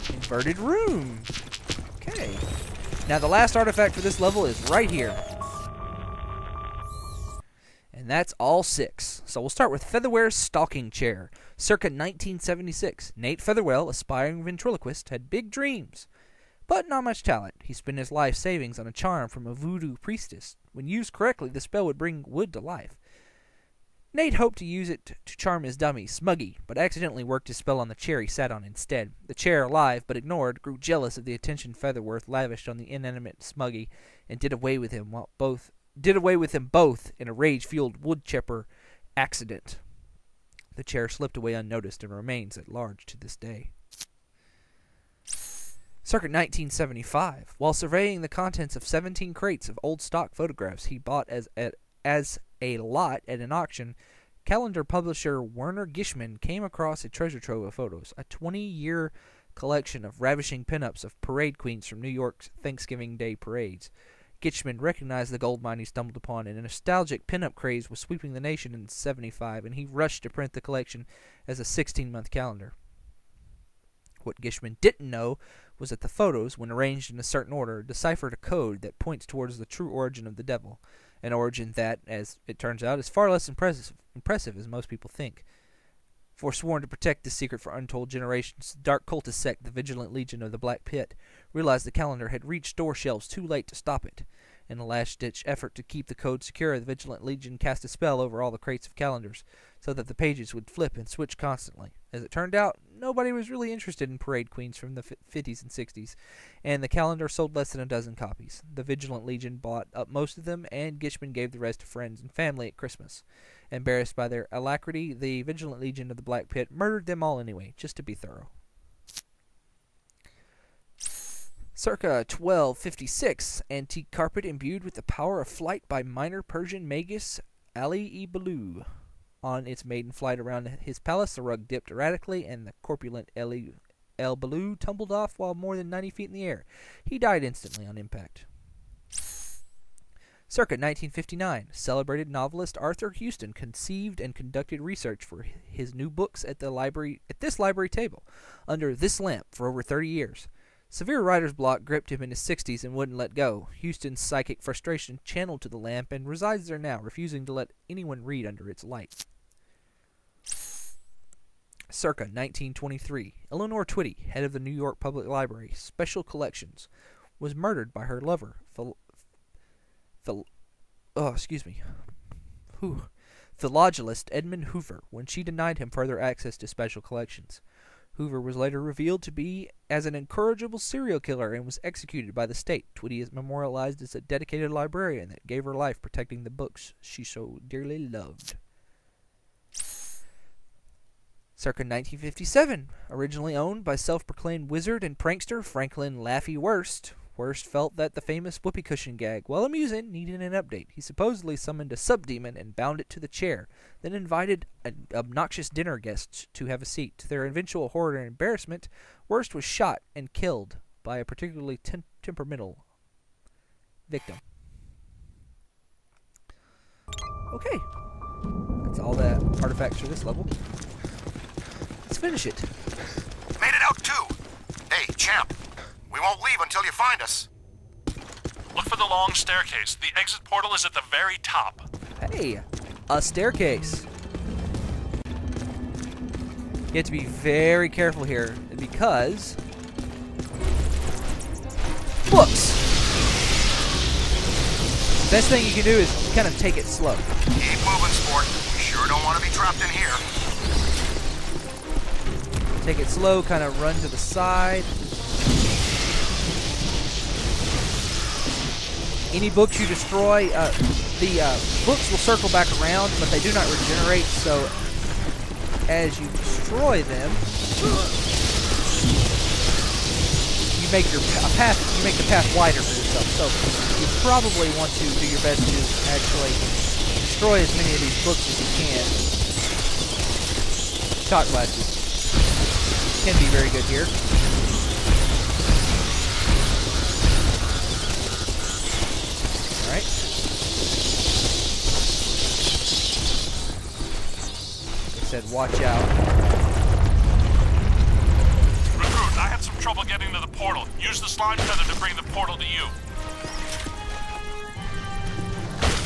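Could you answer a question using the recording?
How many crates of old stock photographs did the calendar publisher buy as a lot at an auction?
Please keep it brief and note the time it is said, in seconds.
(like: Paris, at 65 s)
17, at 48 s.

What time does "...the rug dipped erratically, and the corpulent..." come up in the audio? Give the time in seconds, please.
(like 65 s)
131 s.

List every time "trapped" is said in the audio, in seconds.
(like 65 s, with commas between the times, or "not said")
249 s.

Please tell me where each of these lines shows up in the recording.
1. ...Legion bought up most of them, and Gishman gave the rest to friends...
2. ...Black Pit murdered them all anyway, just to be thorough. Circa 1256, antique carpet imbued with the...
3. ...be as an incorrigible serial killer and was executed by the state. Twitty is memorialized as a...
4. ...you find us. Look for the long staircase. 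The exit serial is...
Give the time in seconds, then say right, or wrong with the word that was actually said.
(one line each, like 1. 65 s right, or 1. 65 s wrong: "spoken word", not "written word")
1. 109 s right
2. 116 s right
3. 179 s right
4. 226 s wrong: "portal", not "serial".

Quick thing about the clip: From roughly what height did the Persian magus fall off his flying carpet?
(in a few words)
90 feet.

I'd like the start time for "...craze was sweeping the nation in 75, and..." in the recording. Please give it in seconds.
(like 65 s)
67 s.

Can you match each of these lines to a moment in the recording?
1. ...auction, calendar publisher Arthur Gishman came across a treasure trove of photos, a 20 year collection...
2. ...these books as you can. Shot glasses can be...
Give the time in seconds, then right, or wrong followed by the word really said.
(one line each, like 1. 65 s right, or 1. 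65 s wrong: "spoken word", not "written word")
1. 53 s wrong: "Werner", not "Arthur"
2. 278 s right.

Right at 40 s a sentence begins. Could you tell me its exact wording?
The chair slipped away unnoticed and remains at large to this day.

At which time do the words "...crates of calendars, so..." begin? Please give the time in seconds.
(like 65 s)
98 s.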